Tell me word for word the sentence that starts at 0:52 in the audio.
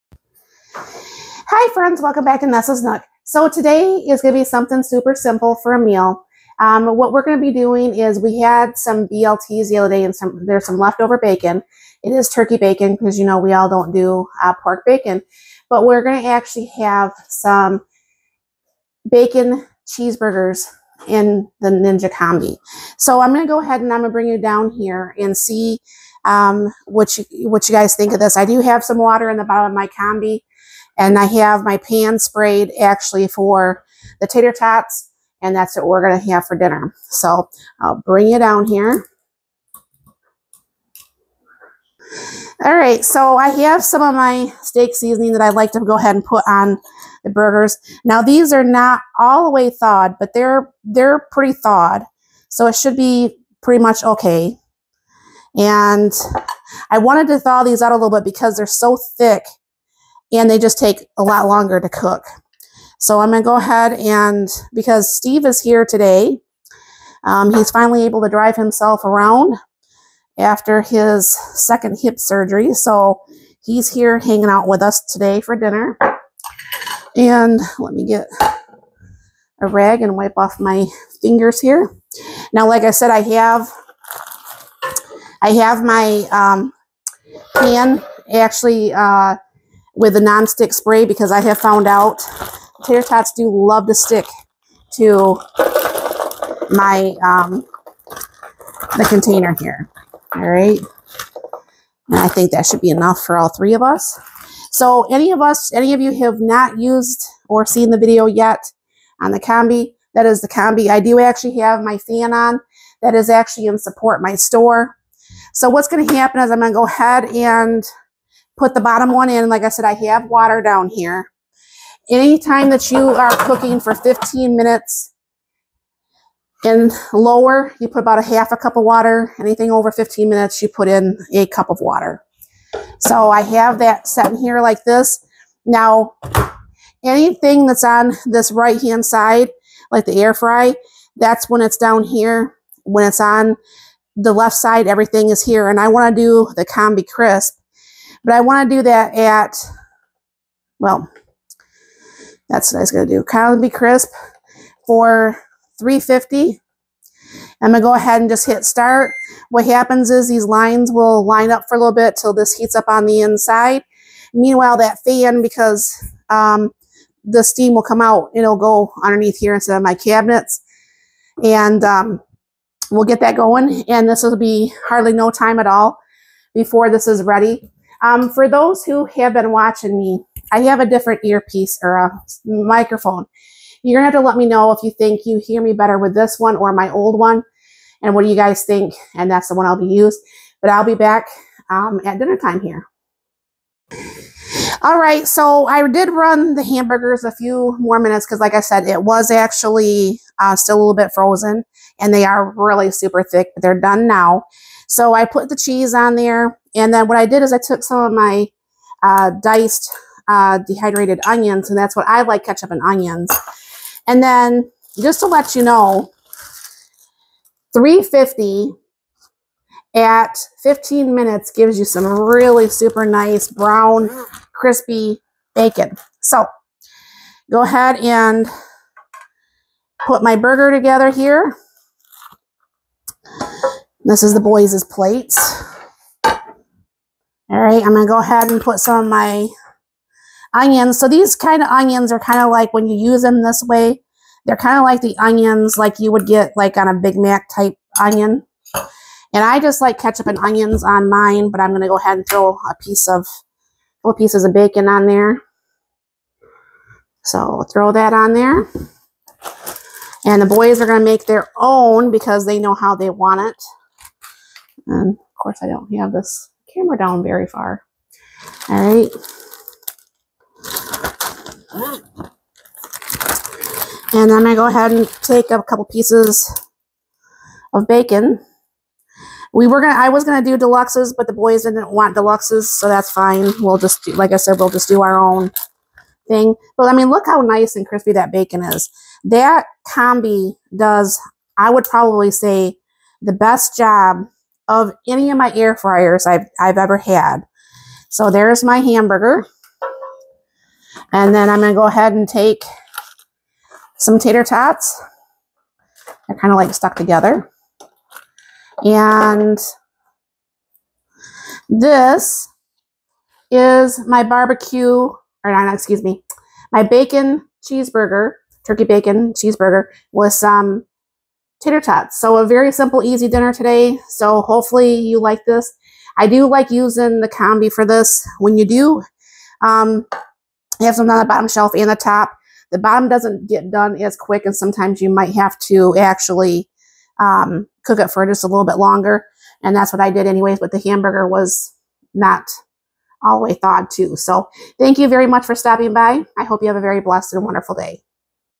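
So it should be pretty much okay.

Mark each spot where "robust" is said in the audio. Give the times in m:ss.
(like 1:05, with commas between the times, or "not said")
not said.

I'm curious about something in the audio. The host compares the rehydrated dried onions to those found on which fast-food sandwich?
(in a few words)
Big Mac.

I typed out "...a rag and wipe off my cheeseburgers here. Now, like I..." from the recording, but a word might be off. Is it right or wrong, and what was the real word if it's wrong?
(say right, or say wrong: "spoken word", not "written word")
wrong: "fingers", not "cheeseburgers".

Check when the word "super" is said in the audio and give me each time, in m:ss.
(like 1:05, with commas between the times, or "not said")
0:04, 3:22, 3:42.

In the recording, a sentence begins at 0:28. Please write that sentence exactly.
I do have some water in the bottom of my combi.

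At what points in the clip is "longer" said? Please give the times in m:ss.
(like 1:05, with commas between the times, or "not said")
1:01, 5:38.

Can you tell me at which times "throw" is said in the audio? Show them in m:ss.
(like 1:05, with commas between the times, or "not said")
4:12, 4:17.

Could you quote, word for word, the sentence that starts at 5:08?
And this is my barbecue, or not, excuse me, my bacon cheeseburger, turkey bacon cheeseburger with some tater tots.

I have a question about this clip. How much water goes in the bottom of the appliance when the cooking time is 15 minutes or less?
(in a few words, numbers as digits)
Half a cup.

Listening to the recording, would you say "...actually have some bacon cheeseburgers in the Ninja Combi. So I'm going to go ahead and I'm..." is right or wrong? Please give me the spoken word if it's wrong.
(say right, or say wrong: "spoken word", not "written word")
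right.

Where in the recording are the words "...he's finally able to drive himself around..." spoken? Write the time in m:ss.
1:07.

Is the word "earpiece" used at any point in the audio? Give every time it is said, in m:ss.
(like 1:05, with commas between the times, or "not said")
3:01.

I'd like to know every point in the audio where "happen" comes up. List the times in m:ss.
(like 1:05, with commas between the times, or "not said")
1:56, 2:39.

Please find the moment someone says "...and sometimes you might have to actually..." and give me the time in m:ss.
5:34.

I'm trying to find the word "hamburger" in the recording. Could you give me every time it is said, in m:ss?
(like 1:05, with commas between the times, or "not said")
3:16, 4:58, 5:40.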